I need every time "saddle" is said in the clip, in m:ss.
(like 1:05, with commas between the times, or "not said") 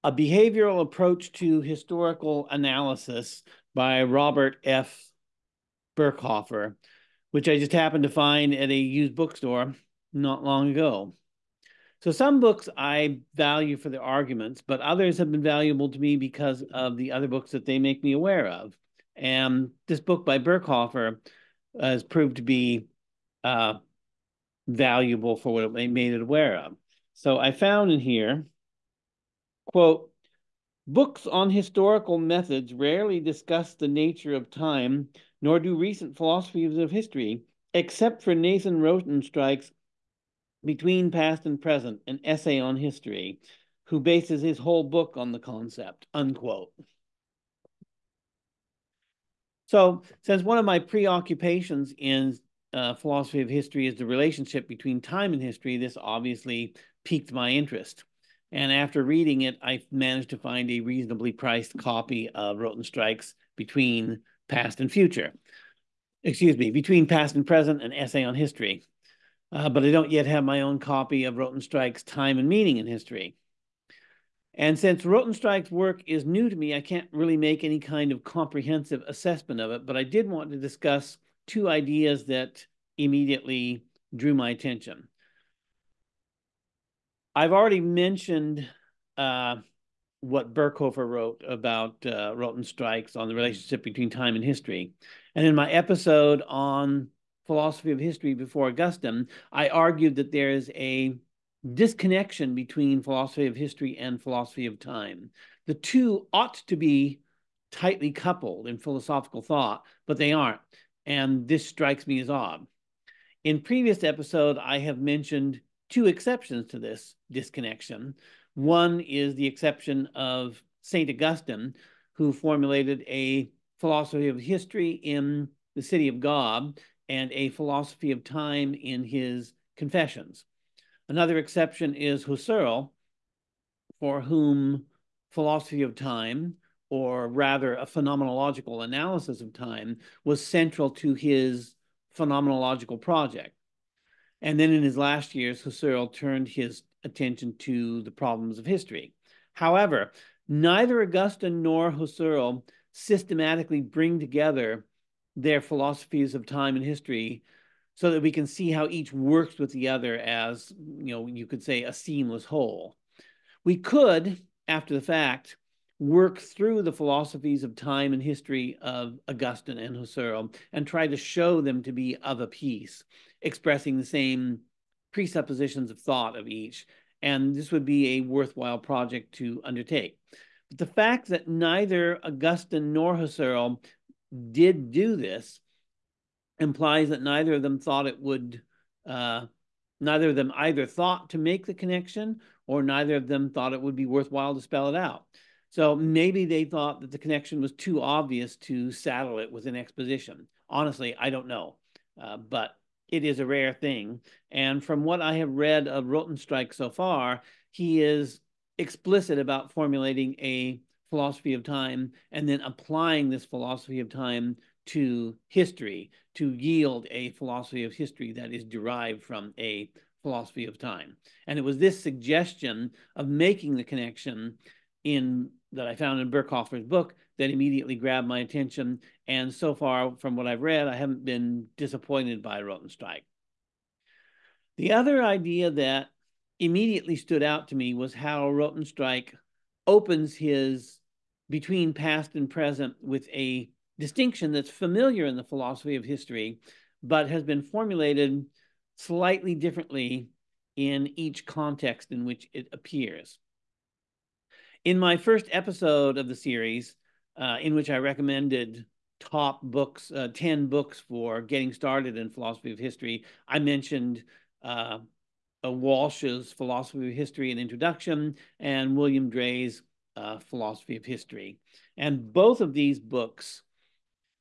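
3:18.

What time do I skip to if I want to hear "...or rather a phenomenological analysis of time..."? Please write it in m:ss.
2:16.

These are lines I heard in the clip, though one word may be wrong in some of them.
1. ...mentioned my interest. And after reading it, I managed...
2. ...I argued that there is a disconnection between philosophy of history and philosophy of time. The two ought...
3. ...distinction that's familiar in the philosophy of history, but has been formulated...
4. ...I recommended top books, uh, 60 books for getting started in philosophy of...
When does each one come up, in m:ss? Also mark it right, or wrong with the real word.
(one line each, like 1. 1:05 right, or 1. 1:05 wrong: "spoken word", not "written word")
1. 0:57 wrong: "piqued", not "mentioned"
2. 1:39 right
3. 4:03 right
4. 4:17 wrong: "10", not "60".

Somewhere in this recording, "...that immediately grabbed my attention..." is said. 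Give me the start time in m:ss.
3:47.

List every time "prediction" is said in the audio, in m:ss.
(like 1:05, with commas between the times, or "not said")
not said.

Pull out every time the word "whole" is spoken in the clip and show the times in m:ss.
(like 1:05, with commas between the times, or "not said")
0:44, 2:42.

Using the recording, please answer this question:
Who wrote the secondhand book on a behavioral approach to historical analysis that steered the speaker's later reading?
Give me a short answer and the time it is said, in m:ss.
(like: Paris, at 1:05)
Robert F. Berkhofer, at 0:04.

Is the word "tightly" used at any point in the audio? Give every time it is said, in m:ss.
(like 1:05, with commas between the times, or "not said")
1:47.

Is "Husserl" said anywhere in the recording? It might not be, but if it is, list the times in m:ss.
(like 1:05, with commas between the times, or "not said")
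2:12, 2:25, 2:31, 2:49, 3:03.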